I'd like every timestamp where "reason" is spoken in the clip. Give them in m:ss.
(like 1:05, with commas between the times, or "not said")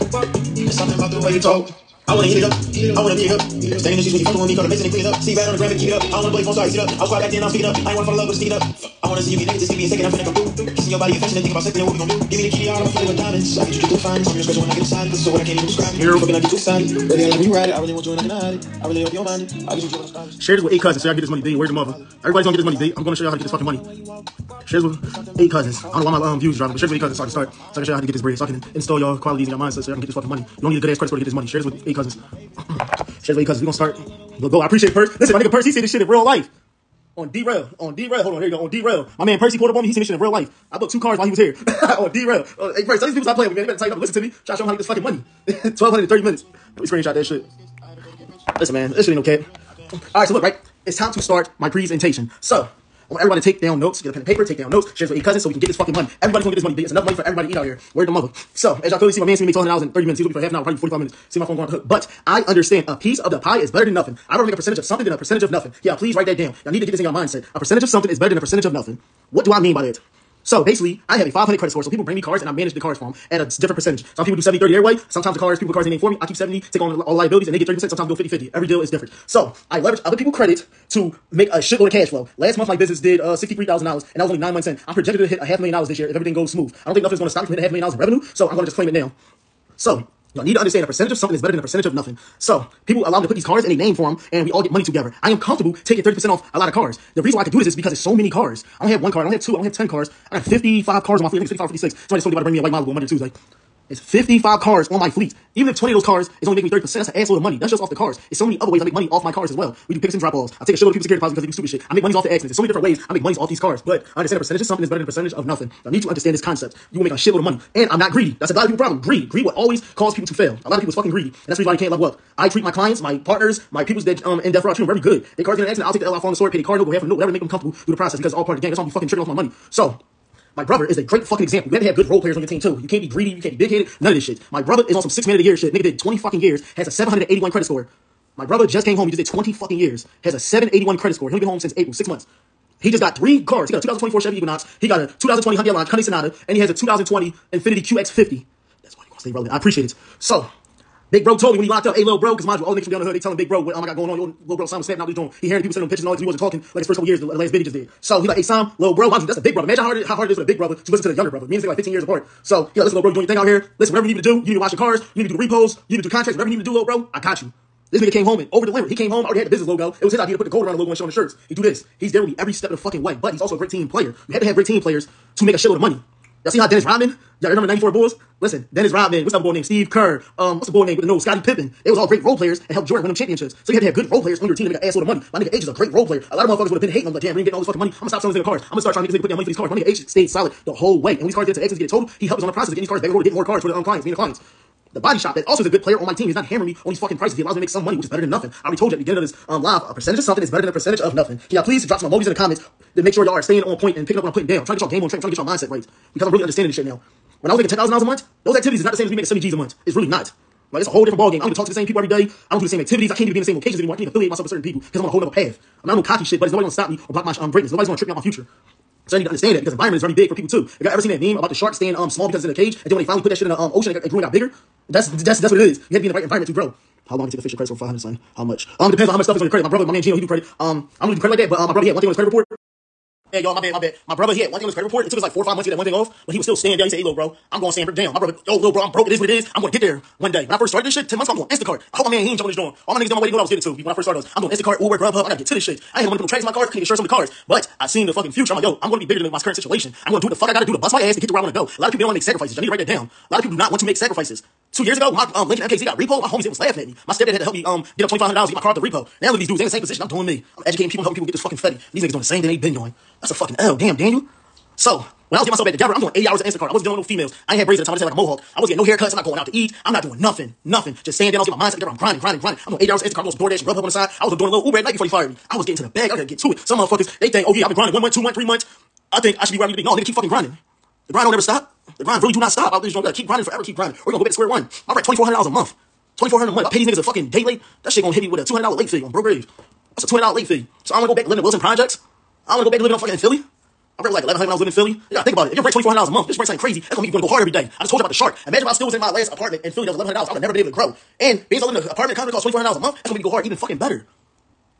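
1:37, 2:01.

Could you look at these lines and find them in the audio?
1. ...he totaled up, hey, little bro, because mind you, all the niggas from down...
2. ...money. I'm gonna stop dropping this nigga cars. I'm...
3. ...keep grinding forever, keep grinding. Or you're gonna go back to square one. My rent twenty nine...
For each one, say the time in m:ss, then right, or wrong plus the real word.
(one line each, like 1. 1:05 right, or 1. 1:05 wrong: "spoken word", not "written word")
1. 2:31 wrong: "locked", not "totaled"
2. 3:07 wrong: "selling", not "dropping"
3. 4:43 wrong: "four", not "nine".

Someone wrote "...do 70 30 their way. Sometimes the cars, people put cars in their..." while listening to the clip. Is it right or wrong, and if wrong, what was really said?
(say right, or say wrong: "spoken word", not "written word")
right.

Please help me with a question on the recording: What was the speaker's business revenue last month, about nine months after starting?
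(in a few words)
$63,000.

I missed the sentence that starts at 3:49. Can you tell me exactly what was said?
My brother, my man Gino, he do credit.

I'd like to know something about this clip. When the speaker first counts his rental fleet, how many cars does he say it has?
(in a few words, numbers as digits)
55.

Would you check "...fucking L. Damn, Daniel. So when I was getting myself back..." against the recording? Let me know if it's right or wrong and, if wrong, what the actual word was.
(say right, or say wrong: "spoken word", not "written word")
right.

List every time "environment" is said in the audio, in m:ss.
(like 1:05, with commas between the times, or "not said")
3:39, 3:46.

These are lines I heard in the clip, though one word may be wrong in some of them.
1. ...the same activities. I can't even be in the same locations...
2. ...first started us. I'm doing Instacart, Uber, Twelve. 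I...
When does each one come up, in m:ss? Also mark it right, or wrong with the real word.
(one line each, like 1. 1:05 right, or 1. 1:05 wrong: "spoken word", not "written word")
1. 3:32 right
2. 4:03 wrong: "Grubhub", not "Twelve".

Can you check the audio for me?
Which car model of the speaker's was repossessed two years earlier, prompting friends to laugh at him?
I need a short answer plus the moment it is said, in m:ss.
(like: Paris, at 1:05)
Lincoln MKZ, at 4:15.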